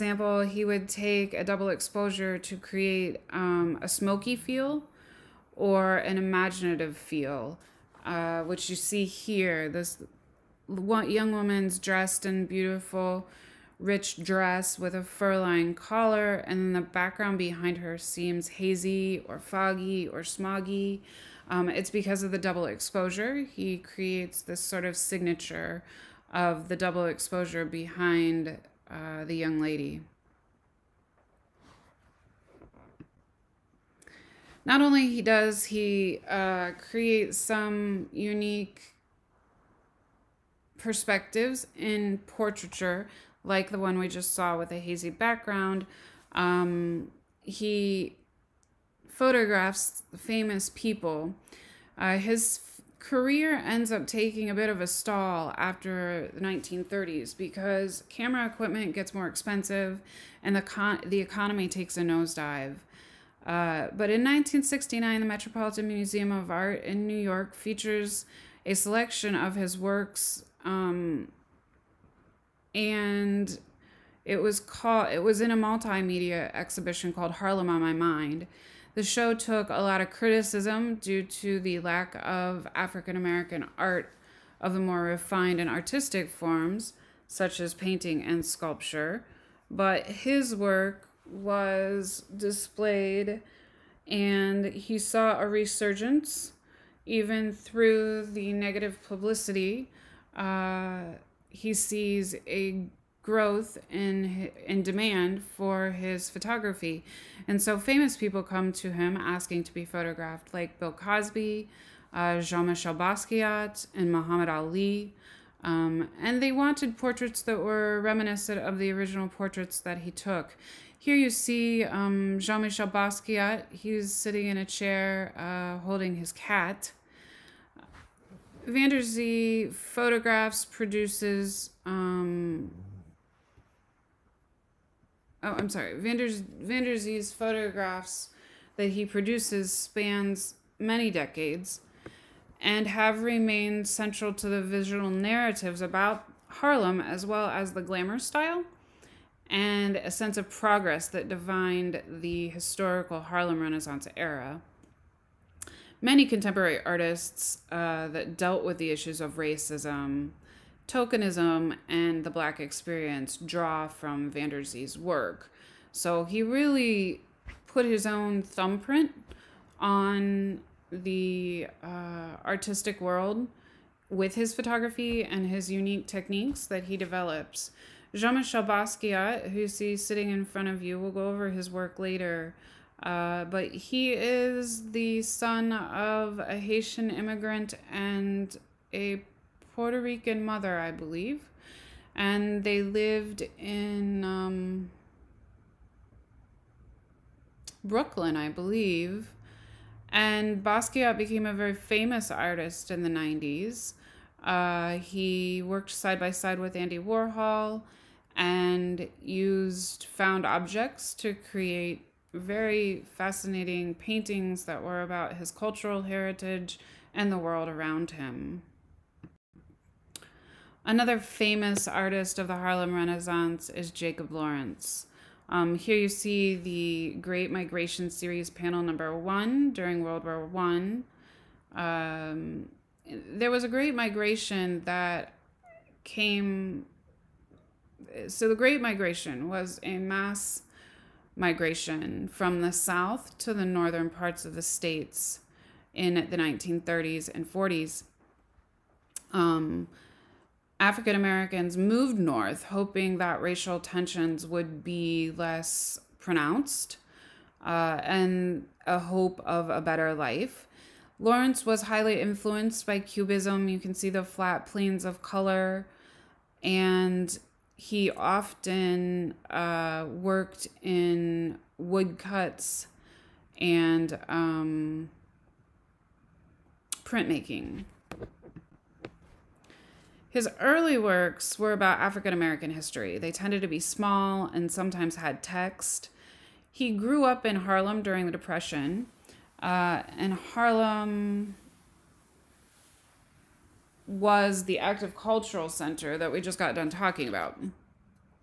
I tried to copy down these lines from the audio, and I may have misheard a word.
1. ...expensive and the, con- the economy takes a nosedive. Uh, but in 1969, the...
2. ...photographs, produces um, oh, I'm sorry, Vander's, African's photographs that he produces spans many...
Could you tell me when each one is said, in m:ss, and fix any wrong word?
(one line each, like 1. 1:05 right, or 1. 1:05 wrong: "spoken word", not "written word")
1. 0:59 right
2. 2:09 wrong: "Vanderzee", not "African".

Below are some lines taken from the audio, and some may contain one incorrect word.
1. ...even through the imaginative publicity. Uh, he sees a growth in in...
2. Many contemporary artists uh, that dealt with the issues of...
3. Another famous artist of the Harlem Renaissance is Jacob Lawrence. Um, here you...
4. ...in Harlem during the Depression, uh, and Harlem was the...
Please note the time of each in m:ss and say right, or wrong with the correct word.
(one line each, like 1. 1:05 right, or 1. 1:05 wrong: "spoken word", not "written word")
1. 1:37 wrong: "negative", not "imaginative"
2. 2:36 right
3. 3:40 right
4. 4:47 right.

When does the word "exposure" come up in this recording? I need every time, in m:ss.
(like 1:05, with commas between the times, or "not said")
0:01, 0:22, 0:27.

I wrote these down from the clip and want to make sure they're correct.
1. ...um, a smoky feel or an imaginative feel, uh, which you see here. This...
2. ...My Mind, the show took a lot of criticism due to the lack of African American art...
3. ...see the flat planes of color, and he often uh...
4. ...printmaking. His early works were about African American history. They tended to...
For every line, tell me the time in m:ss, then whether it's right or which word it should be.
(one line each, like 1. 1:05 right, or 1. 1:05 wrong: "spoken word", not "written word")
1. 0:03 right
2. 1:17 right
3. 4:23 right
4. 4:37 right.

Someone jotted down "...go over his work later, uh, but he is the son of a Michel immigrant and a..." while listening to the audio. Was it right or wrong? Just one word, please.
wrong.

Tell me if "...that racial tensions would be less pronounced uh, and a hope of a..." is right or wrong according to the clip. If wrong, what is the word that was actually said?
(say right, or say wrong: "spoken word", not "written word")
right.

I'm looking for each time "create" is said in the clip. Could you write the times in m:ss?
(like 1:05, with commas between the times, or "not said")
0:02, 0:23, 0:36, 3:31.